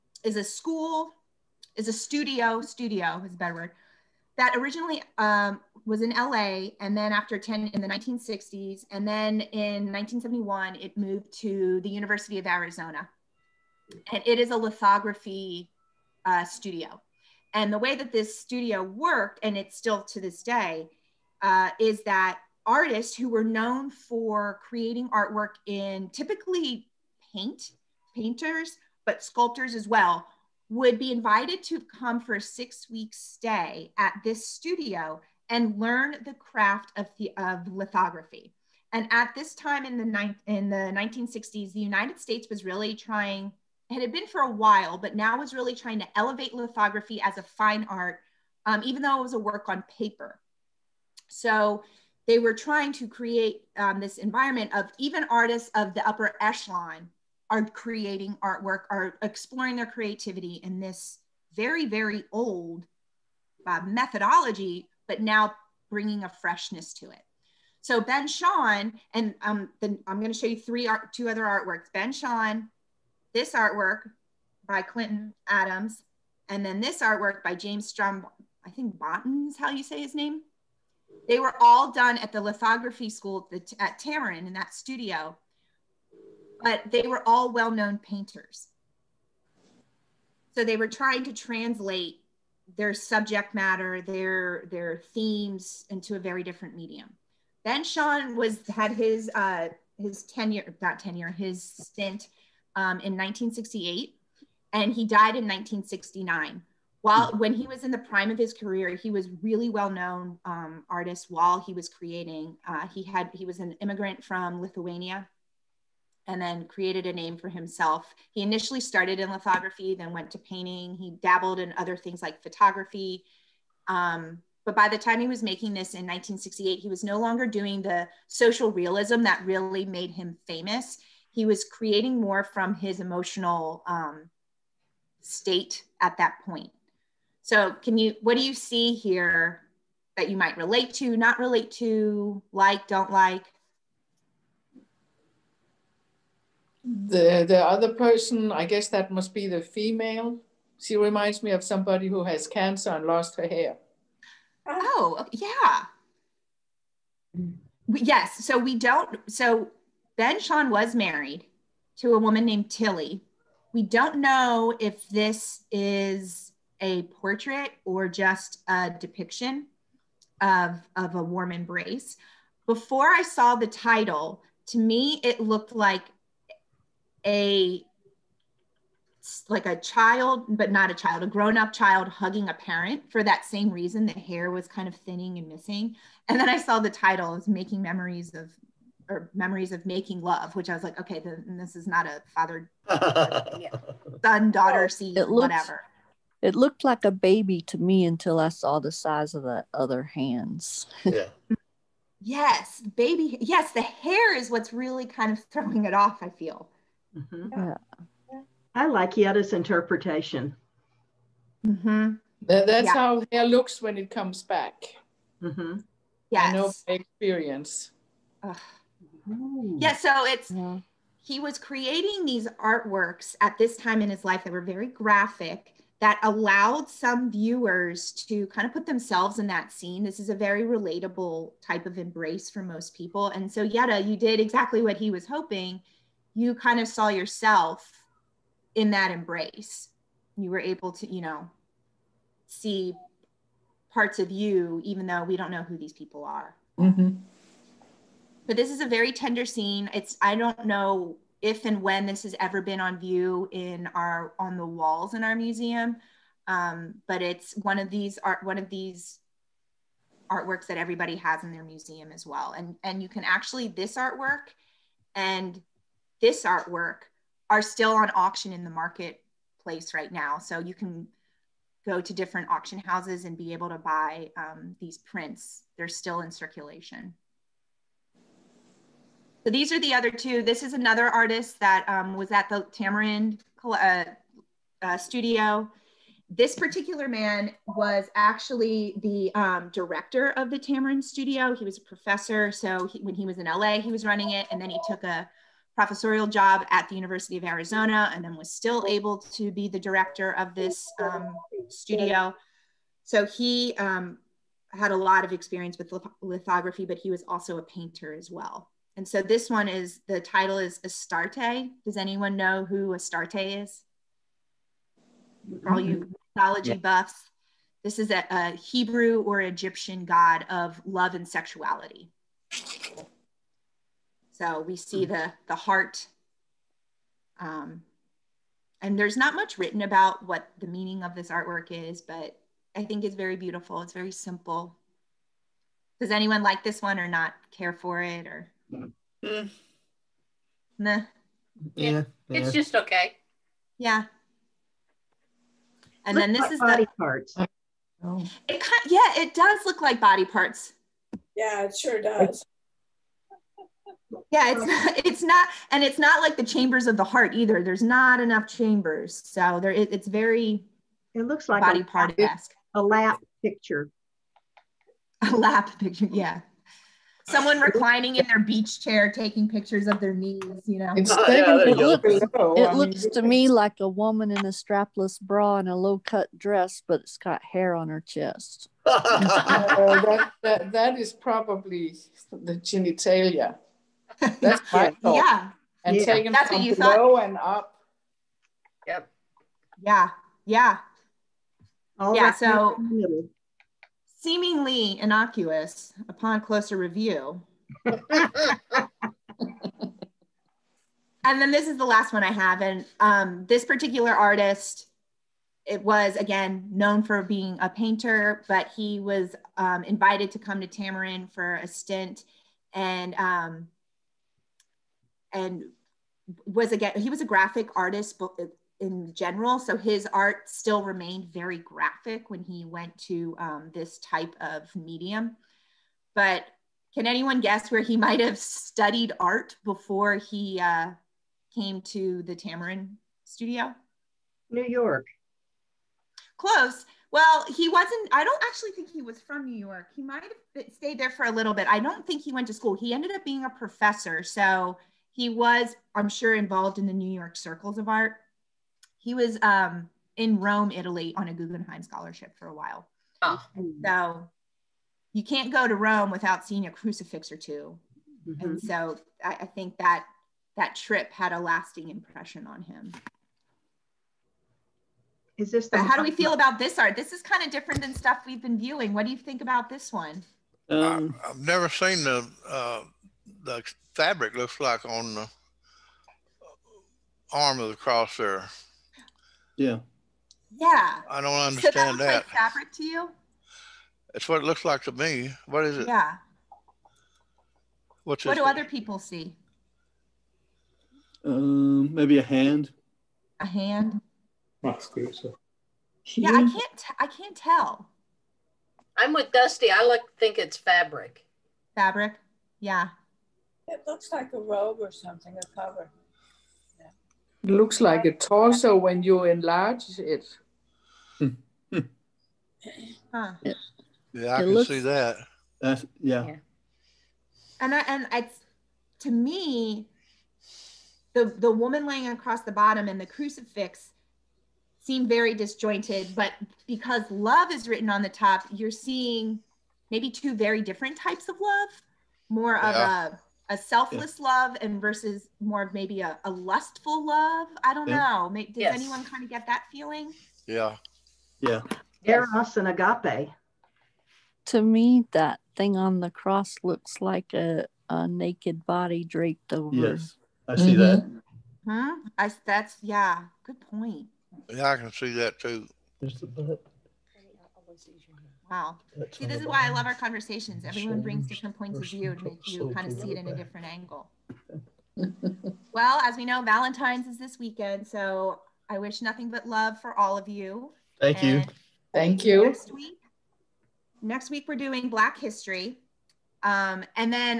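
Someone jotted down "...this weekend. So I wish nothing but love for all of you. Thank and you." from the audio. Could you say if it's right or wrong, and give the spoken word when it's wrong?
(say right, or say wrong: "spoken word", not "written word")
right.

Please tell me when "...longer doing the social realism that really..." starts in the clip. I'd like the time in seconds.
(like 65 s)
127 s.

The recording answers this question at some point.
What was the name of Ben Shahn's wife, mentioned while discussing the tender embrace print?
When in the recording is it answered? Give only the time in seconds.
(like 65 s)
162 s.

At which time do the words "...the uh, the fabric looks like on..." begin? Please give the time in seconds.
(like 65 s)
472 s.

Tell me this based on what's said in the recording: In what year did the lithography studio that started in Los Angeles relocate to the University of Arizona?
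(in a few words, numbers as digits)
1971.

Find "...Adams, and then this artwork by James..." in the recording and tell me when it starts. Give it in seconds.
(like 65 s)
75 s.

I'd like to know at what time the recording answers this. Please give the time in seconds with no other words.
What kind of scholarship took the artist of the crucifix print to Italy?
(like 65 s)
451 s.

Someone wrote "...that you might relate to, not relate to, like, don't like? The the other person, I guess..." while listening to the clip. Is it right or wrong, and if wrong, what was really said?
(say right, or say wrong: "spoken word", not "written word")
right.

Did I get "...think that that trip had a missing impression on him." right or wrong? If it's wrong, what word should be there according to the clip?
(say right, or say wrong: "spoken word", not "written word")
wrong: "lasting", not "missing".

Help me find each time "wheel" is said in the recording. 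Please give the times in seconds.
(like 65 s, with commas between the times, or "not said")
not said.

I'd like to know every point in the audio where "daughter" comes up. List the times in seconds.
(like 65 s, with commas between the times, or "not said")
194 s.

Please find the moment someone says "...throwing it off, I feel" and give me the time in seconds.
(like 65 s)
205 s.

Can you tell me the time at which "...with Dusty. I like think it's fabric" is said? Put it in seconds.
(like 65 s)
499 s.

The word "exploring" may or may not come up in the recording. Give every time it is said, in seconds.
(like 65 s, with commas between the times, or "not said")
59 s.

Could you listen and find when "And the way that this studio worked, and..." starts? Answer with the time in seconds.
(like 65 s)
17 s.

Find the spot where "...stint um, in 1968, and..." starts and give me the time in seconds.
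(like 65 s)
101 s.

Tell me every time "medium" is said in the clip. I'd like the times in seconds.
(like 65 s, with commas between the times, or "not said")
96 s, 424 s.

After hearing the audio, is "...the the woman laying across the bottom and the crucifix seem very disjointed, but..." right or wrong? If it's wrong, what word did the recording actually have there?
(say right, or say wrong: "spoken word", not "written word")
right.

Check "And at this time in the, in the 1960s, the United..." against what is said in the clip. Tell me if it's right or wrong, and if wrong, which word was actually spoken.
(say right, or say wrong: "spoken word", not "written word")
right.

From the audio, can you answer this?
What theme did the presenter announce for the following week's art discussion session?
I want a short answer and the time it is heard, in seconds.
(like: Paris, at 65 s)
Black History, at 574 s.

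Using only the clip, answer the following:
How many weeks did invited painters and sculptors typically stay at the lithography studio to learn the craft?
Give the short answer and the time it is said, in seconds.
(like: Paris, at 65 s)
6, at 32 s.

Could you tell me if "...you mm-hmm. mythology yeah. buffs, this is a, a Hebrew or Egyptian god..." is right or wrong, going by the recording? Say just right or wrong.
right.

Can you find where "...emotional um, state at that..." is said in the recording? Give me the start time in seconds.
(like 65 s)
132 s.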